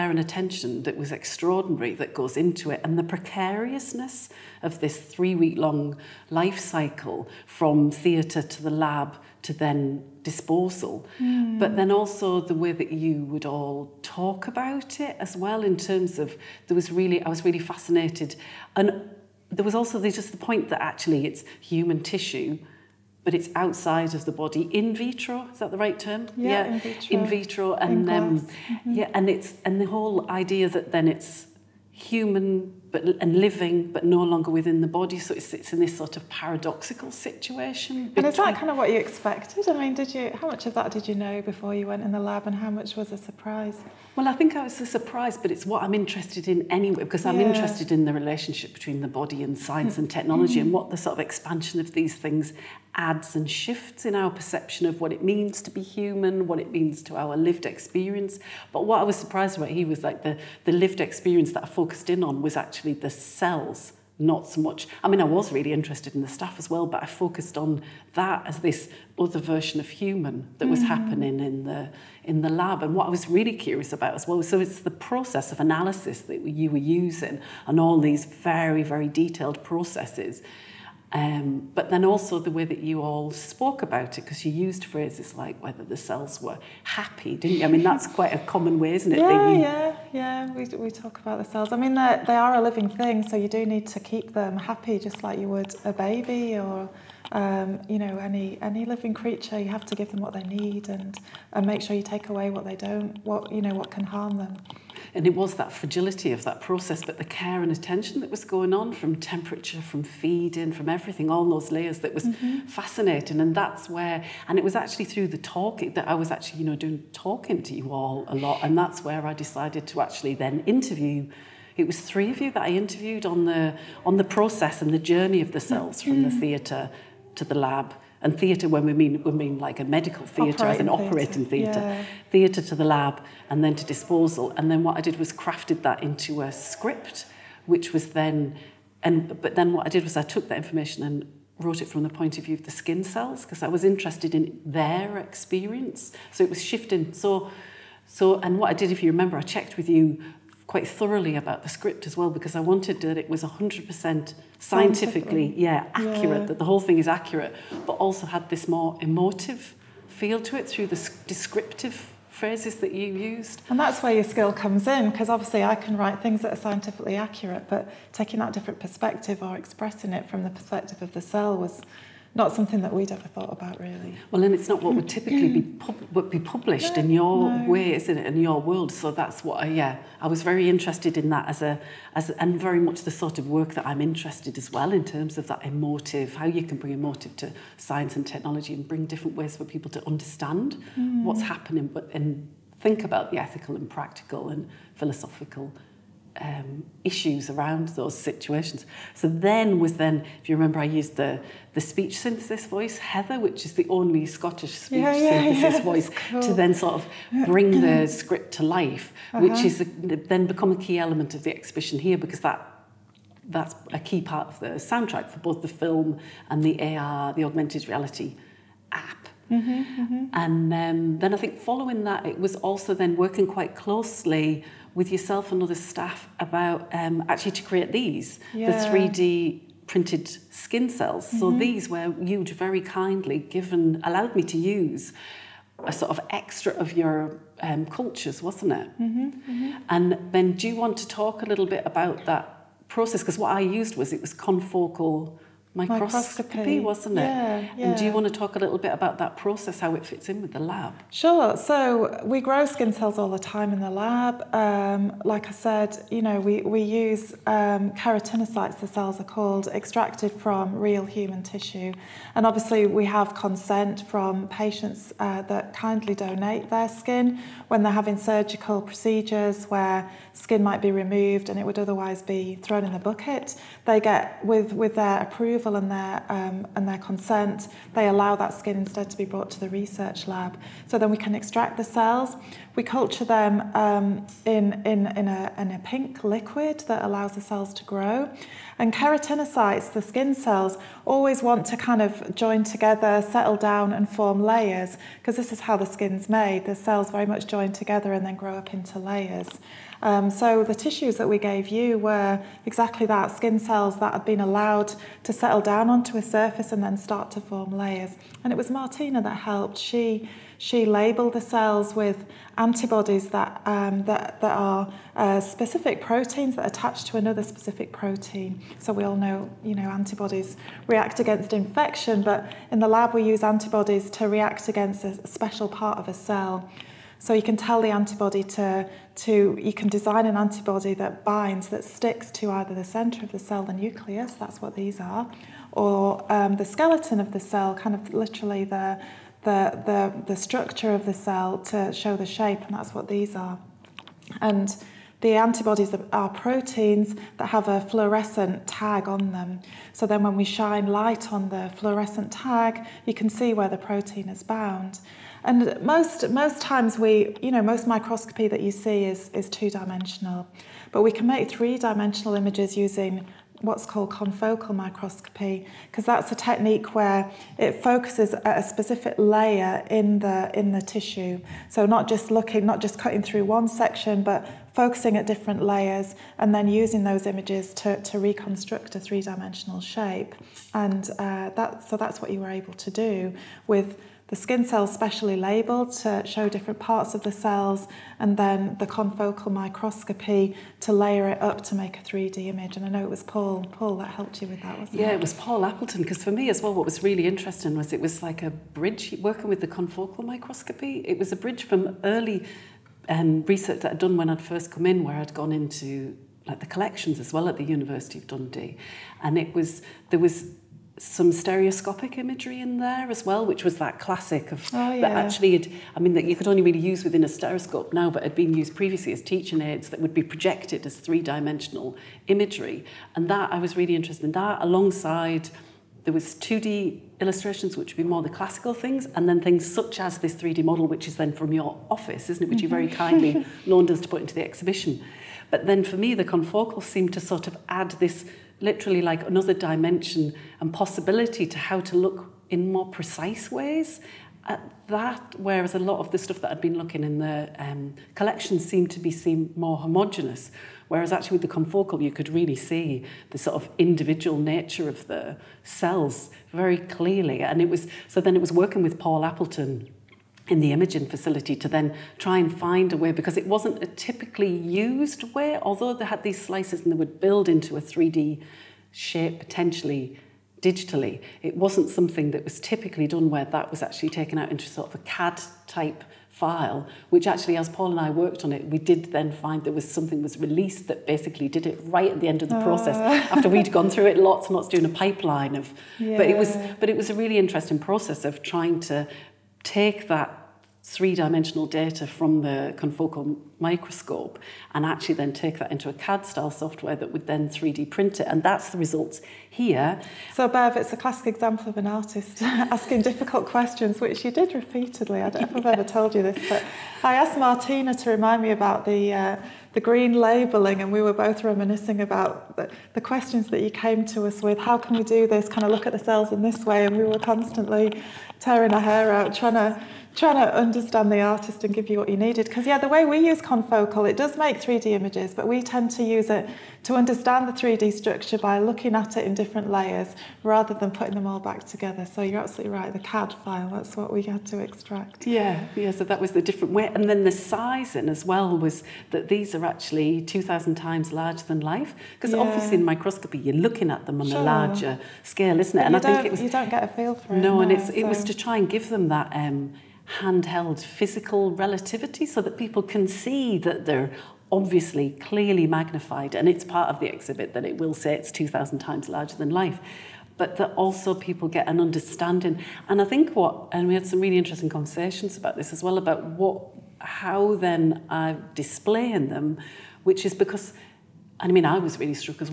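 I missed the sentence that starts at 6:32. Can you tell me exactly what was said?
And I know it was Paul, Paul that helped you with that, wasn't yeah, it?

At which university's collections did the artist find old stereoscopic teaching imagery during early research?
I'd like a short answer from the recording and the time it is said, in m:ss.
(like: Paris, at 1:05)
University of Dundee, at 6:47.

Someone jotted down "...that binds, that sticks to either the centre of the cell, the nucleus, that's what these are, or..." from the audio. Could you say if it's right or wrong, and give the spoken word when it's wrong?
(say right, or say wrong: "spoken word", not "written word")
right.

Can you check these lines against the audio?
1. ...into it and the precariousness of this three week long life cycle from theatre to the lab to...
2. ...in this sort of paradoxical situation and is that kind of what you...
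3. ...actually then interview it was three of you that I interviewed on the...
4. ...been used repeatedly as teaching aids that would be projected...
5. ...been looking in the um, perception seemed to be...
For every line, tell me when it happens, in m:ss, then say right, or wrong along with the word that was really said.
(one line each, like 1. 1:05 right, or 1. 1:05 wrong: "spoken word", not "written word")
1. 0:02 right
2. 0:35 right
3. 1:59 right
4. 6:58 wrong: "previously", not "repeatedly"
5. 7:26 wrong: "collection", not "perception".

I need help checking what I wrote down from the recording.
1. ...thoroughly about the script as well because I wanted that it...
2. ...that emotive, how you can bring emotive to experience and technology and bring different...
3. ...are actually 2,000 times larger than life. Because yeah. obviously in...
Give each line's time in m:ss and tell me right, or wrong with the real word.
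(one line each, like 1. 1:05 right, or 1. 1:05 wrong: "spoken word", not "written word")
1. 2:30 right
2. 3:05 wrong: "science", not "experience"
3. 8:59 right.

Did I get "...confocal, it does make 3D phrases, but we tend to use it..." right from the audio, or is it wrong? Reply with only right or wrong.
wrong.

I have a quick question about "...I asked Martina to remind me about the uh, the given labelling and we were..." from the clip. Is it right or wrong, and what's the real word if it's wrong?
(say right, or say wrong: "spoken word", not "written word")
wrong: "green", not "given".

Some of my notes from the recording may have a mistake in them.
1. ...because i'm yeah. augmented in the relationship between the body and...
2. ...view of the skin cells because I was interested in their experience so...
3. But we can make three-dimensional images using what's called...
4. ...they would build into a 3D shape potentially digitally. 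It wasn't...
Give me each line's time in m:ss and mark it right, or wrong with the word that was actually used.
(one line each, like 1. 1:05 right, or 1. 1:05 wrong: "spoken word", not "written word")
1. 0:47 wrong: "interested", not "augmented"
2. 2:22 right
3. 6:00 right
4. 7:46 right.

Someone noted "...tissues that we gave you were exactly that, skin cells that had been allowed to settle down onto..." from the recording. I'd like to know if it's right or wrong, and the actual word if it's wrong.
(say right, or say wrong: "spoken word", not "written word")
right.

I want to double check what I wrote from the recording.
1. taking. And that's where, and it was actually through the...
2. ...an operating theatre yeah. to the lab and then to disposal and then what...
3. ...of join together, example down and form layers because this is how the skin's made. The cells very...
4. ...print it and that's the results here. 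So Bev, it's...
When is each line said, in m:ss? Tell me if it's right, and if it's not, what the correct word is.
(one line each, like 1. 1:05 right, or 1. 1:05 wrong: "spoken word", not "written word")
1. 1:52 wrong: "fascinating", not "taking"
2. 2:10 right
3. 4:51 wrong: "settle", not "example"
4. 8:17 right.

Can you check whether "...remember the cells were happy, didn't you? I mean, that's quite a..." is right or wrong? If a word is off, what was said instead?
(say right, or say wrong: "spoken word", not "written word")
wrong: "whether", not "remember".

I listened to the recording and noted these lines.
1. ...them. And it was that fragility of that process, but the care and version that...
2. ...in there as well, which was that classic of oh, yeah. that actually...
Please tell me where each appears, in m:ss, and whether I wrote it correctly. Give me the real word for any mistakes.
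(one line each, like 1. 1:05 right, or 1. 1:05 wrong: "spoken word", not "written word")
1. 1:44 wrong: "attention", not "version"
2. 6:52 right.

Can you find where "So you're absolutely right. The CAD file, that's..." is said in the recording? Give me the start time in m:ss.
8:52.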